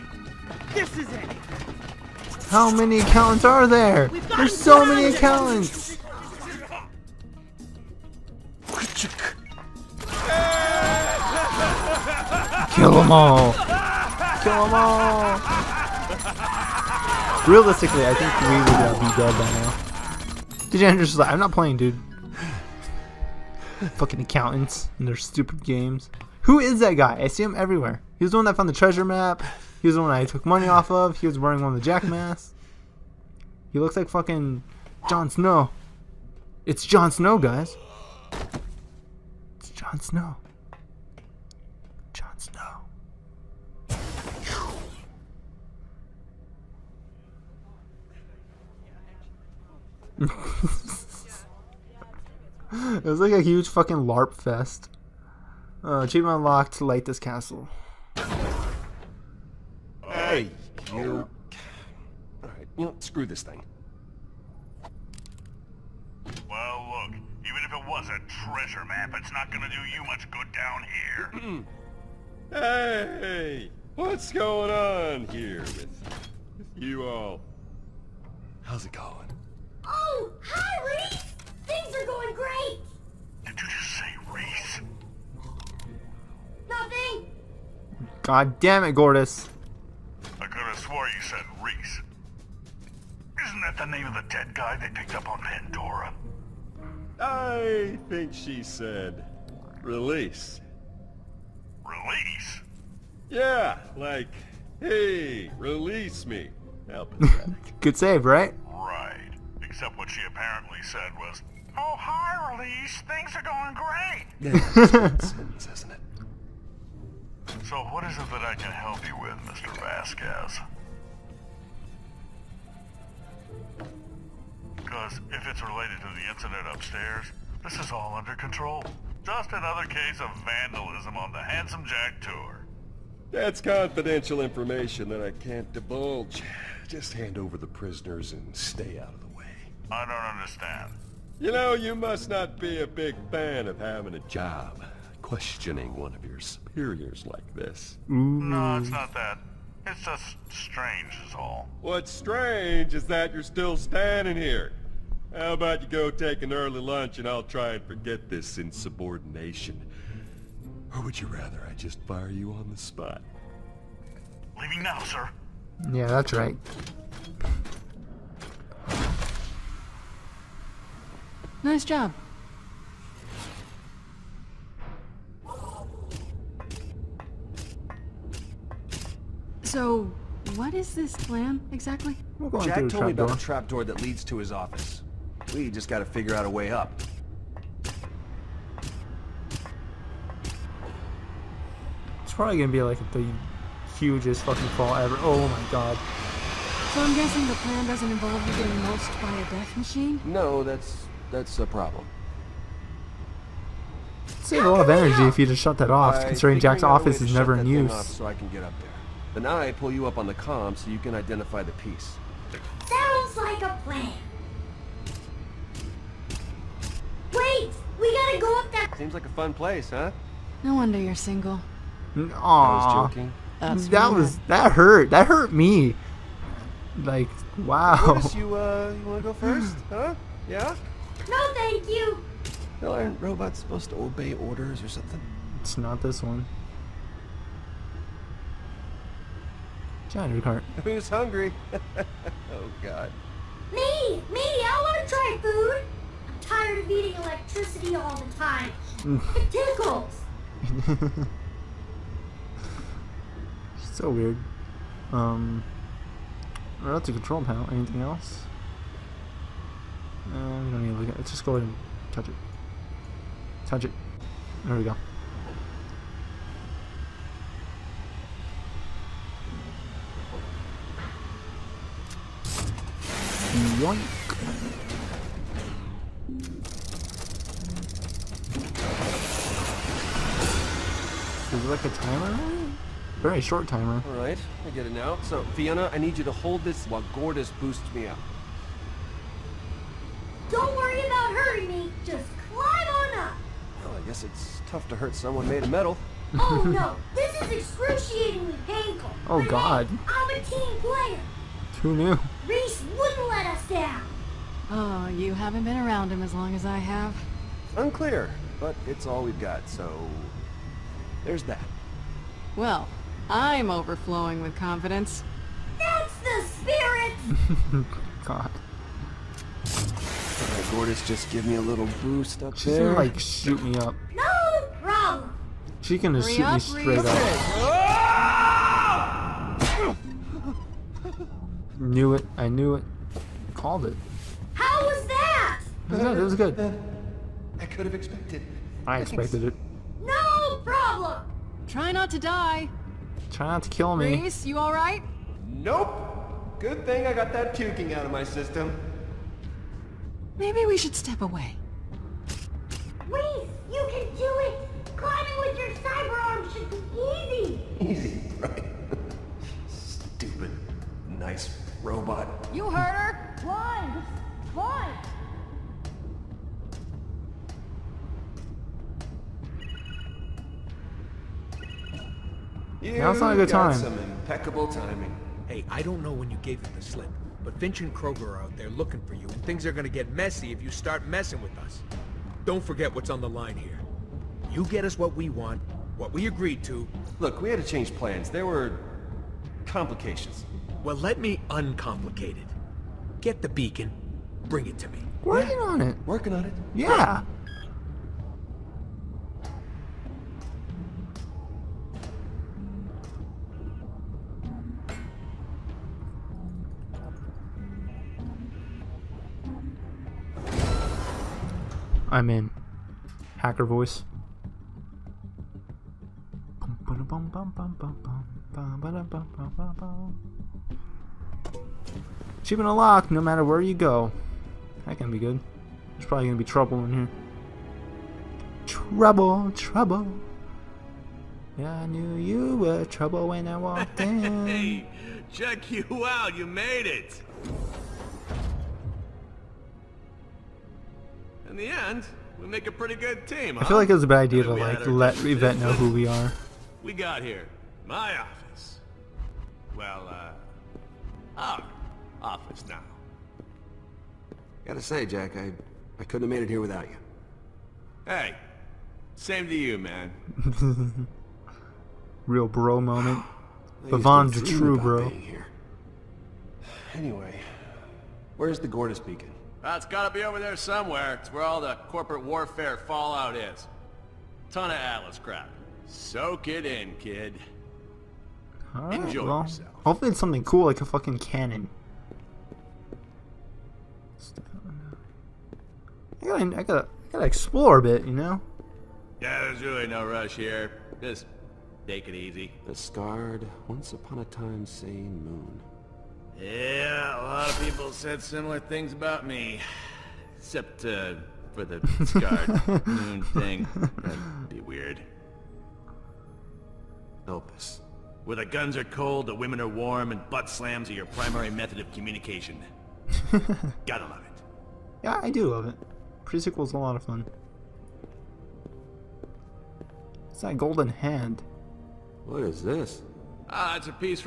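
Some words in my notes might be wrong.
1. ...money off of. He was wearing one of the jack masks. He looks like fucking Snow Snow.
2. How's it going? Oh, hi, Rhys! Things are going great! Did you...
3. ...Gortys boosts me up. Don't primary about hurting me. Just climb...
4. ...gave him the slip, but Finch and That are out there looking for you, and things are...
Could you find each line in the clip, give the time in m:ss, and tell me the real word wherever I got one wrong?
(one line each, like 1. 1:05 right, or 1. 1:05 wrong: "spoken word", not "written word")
1. 0:30 wrong: "Jon", not "Snow"
2. 1:18 right
3. 4:47 wrong: "worry", not "primary"
4. 6:16 wrong: "Kroger", not "That".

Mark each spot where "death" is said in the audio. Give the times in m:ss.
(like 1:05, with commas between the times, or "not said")
3:19.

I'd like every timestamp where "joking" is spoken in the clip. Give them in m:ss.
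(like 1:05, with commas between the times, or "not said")
3:43.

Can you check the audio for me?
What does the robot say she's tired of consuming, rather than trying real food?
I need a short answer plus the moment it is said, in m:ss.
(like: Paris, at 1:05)
Electricity, at 4:07.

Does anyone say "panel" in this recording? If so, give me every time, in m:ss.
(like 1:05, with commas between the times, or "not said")
4:17.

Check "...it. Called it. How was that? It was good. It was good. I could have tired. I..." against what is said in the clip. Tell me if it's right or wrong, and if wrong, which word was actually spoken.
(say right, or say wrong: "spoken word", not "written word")
wrong: "expected", not "tired".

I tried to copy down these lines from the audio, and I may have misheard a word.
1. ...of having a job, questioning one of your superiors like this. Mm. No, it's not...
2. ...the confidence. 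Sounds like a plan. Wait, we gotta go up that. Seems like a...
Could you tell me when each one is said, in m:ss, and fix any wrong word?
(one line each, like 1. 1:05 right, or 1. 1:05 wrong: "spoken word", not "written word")
1. 2:23 right
2. 3:31 wrong: "piece", not "confidence".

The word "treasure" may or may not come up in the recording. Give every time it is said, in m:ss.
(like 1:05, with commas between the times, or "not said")
0:28, 1:08.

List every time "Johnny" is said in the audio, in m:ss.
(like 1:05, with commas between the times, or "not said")
4:00.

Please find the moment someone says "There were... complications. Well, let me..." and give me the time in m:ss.
6:28.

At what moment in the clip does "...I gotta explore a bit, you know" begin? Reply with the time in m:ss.
8:07.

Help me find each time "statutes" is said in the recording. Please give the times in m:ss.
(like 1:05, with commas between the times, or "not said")
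not said.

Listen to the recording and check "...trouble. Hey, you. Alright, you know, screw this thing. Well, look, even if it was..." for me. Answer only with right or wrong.
wrong.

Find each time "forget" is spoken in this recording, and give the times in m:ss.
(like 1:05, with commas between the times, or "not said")
2:37, 6:22.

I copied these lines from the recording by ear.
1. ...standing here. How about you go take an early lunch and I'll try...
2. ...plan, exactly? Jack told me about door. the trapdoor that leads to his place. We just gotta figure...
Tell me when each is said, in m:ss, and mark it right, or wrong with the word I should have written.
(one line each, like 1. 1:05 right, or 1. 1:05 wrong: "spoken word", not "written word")
1. 2:33 right
2. 3:01 wrong: "office", not "place".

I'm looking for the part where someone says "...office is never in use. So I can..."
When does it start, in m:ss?
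3:26.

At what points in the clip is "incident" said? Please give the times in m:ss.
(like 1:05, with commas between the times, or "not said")
2:06.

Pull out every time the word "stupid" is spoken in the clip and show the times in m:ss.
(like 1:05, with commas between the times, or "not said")
0:25, 5:59.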